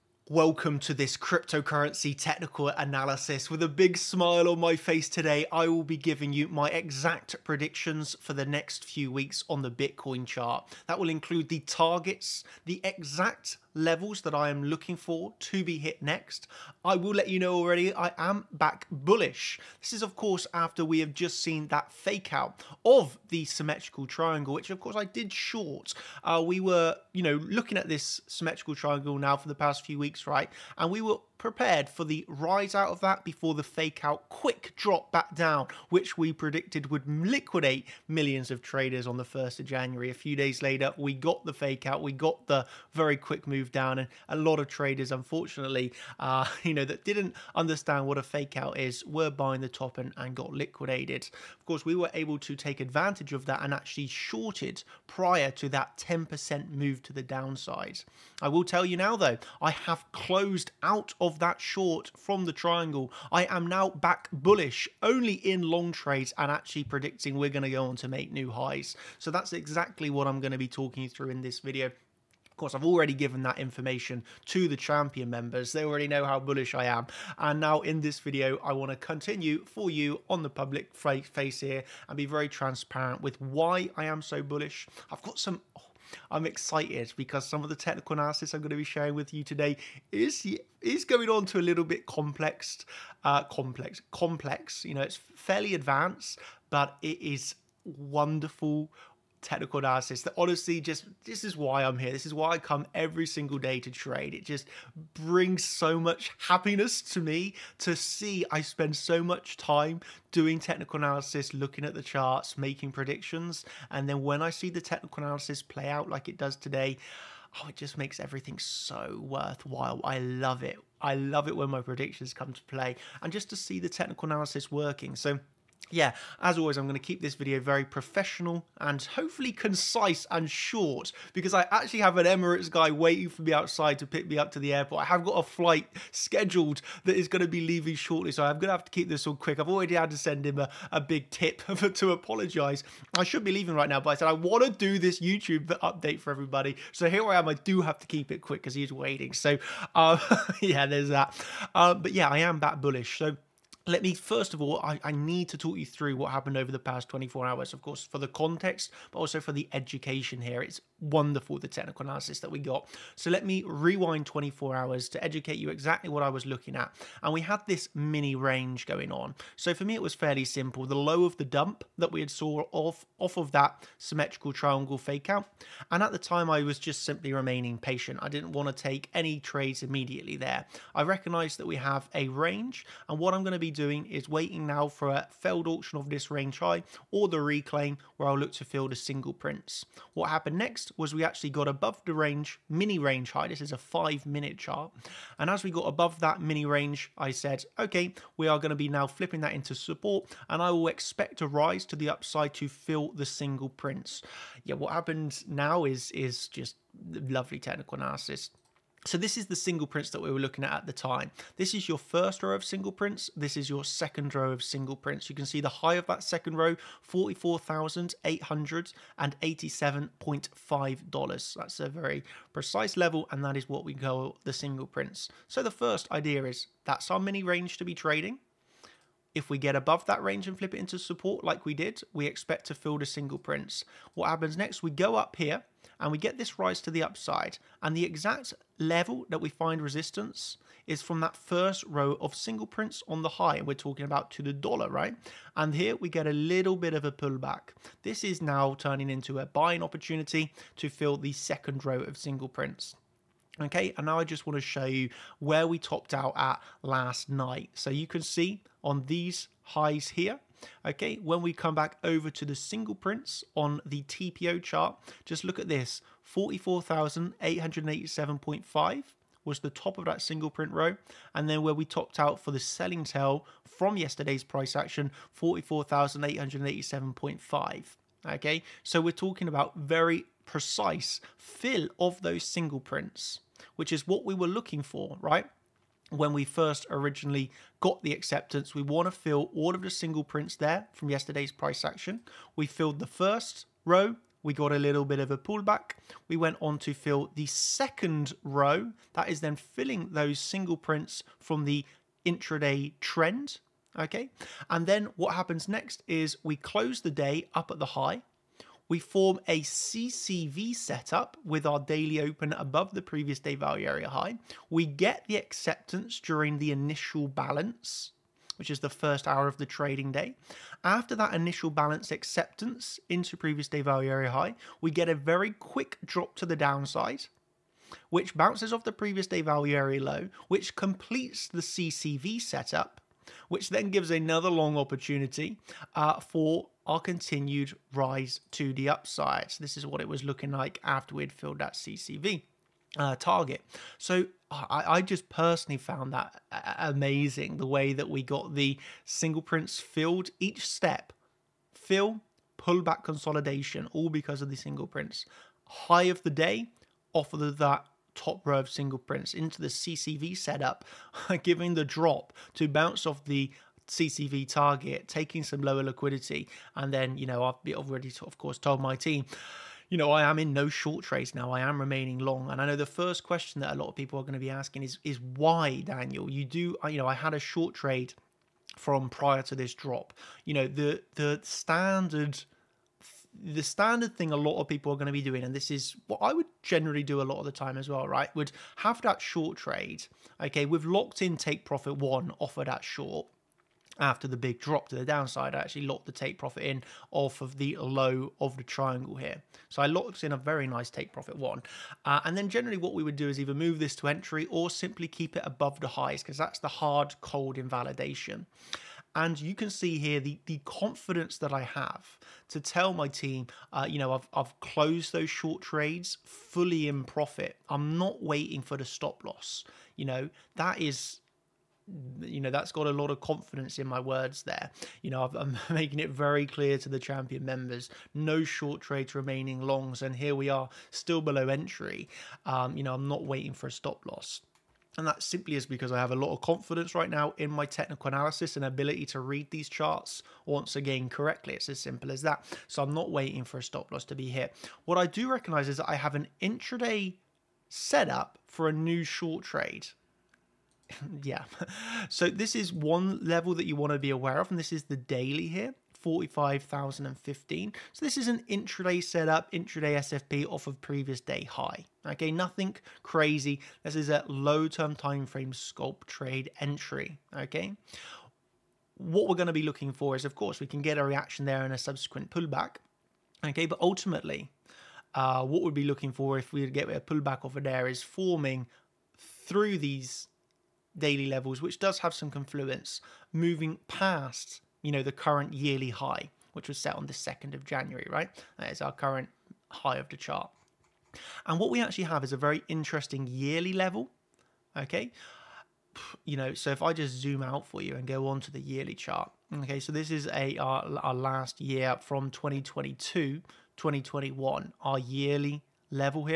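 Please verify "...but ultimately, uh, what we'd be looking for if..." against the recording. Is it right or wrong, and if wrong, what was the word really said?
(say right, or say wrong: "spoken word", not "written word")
right.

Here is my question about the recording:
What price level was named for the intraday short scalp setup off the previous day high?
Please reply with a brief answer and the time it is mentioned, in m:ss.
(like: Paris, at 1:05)
45,015, at 7:35.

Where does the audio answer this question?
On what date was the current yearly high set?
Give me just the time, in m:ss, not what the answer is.
8:07.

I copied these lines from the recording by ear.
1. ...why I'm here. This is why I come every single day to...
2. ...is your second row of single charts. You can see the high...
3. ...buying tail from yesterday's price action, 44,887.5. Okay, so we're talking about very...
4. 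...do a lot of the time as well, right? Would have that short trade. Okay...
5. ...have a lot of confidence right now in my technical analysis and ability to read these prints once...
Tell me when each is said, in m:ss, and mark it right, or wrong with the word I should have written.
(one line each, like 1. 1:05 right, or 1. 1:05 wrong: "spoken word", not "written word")
1. 1:41 right
2. 3:33 wrong: "prints", not "charts"
3. 4:32 wrong: "selling", not "buying"
4. 6:27 right
5. 7:15 wrong: "charts", not "prints".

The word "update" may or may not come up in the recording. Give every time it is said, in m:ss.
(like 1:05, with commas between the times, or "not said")
2:25.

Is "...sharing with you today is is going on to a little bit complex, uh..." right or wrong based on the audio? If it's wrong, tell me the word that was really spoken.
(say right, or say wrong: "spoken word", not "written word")
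right.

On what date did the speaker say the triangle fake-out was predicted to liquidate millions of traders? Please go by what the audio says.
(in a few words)
1st of January.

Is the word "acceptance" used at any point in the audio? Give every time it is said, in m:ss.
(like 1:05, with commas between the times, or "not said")
4:48, 5:15, 5:22.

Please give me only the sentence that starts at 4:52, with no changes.
We filled the first row, we got a little bit of a pullback.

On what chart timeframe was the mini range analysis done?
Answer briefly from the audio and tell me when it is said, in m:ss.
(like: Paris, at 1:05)
five minute, at 3:13.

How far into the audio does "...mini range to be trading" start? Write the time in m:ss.
3:47.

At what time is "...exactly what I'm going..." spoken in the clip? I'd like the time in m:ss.
1:09.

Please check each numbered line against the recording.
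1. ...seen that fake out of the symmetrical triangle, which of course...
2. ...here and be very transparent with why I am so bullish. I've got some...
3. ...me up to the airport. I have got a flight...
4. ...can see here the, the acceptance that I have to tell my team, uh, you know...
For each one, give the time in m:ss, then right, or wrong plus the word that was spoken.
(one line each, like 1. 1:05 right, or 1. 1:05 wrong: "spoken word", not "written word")
1. 0:21 right
2. 1:21 right
3. 2:14 right
4. 6:49 wrong: "confidence", not "acceptance".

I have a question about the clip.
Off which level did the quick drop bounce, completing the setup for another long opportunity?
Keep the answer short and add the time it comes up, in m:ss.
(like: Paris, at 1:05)
previous day value area low, at 5:28.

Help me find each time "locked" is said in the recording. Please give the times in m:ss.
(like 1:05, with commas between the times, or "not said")
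6:30, 6:35, 6:39.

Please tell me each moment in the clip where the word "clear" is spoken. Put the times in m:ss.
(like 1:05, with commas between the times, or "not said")
7:06.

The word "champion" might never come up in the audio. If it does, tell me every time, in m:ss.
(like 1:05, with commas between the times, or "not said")
1:14, 7:06.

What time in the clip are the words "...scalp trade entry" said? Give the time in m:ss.
7:45.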